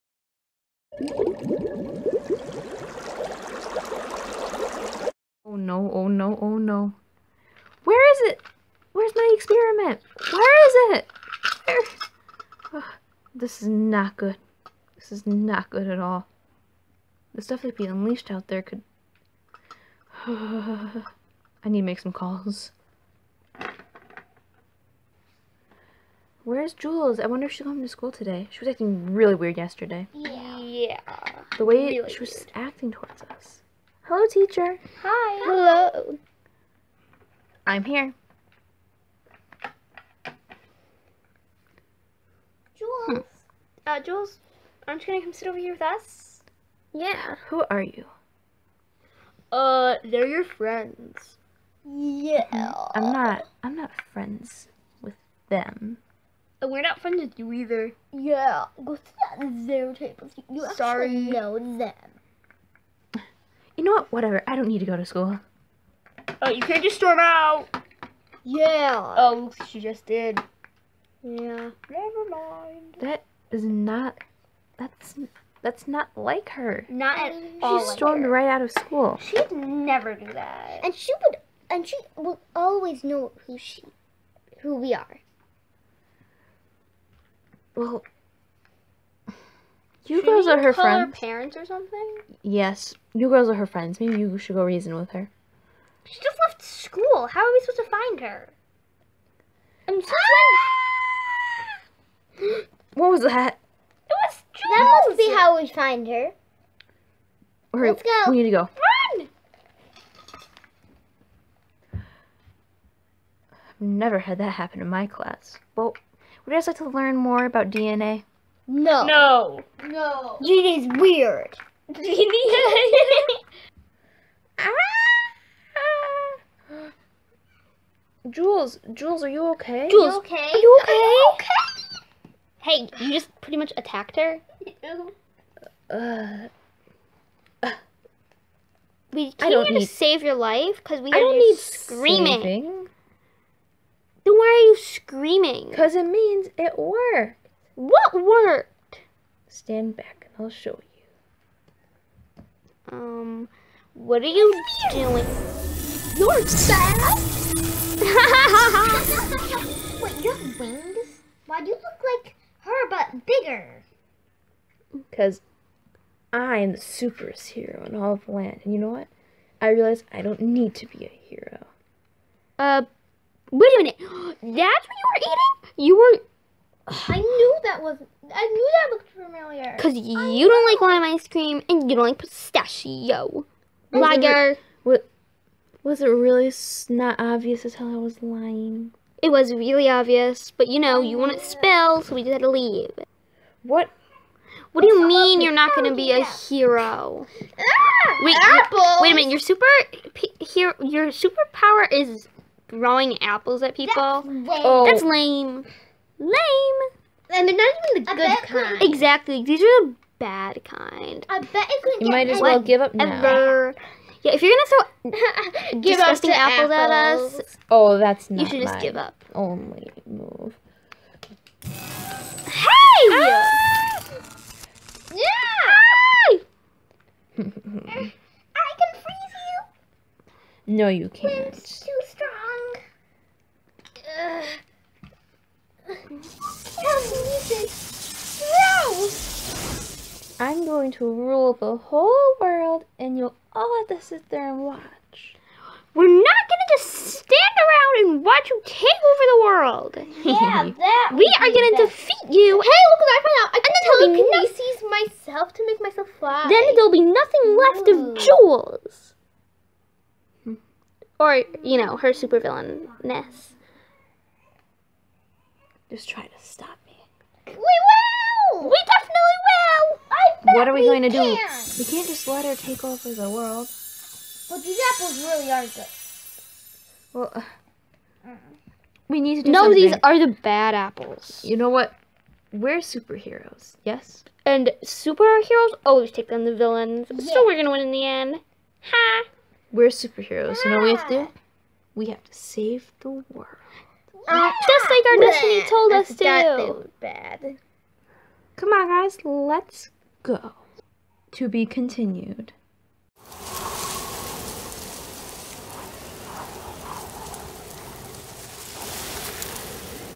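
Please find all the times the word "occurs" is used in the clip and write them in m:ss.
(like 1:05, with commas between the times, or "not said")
not said.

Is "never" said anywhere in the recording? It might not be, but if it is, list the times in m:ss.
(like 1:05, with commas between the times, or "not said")
1:11, 1:19, 1:53.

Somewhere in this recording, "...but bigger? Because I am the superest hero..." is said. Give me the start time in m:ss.
2:42.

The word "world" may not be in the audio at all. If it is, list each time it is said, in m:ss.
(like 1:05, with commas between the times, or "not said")
4:02, 4:09, 4:33, 4:53.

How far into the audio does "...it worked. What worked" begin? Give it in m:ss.
2:26.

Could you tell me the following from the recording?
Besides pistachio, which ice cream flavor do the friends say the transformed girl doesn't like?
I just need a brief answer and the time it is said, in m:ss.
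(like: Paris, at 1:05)
Lime, at 3:00.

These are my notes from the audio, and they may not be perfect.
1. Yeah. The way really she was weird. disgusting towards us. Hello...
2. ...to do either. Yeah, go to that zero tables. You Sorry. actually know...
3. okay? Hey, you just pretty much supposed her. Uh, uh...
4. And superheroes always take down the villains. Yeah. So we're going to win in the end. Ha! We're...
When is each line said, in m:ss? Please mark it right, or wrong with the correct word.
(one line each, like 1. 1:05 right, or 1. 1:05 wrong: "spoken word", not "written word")
1. 0:30 wrong: "acting", not "disgusting"
2. 0:57 right
3. 2:11 wrong: "attacked", not "supposed"
4. 4:44 right.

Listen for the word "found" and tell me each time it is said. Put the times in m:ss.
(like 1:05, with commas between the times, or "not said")
4:13.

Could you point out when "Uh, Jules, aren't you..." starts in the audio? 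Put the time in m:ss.
0:43.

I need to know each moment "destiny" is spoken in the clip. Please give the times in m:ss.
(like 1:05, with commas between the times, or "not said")
4:55.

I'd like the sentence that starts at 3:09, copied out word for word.
It was really obvious, but you know, you want to spill, so we just had to leave.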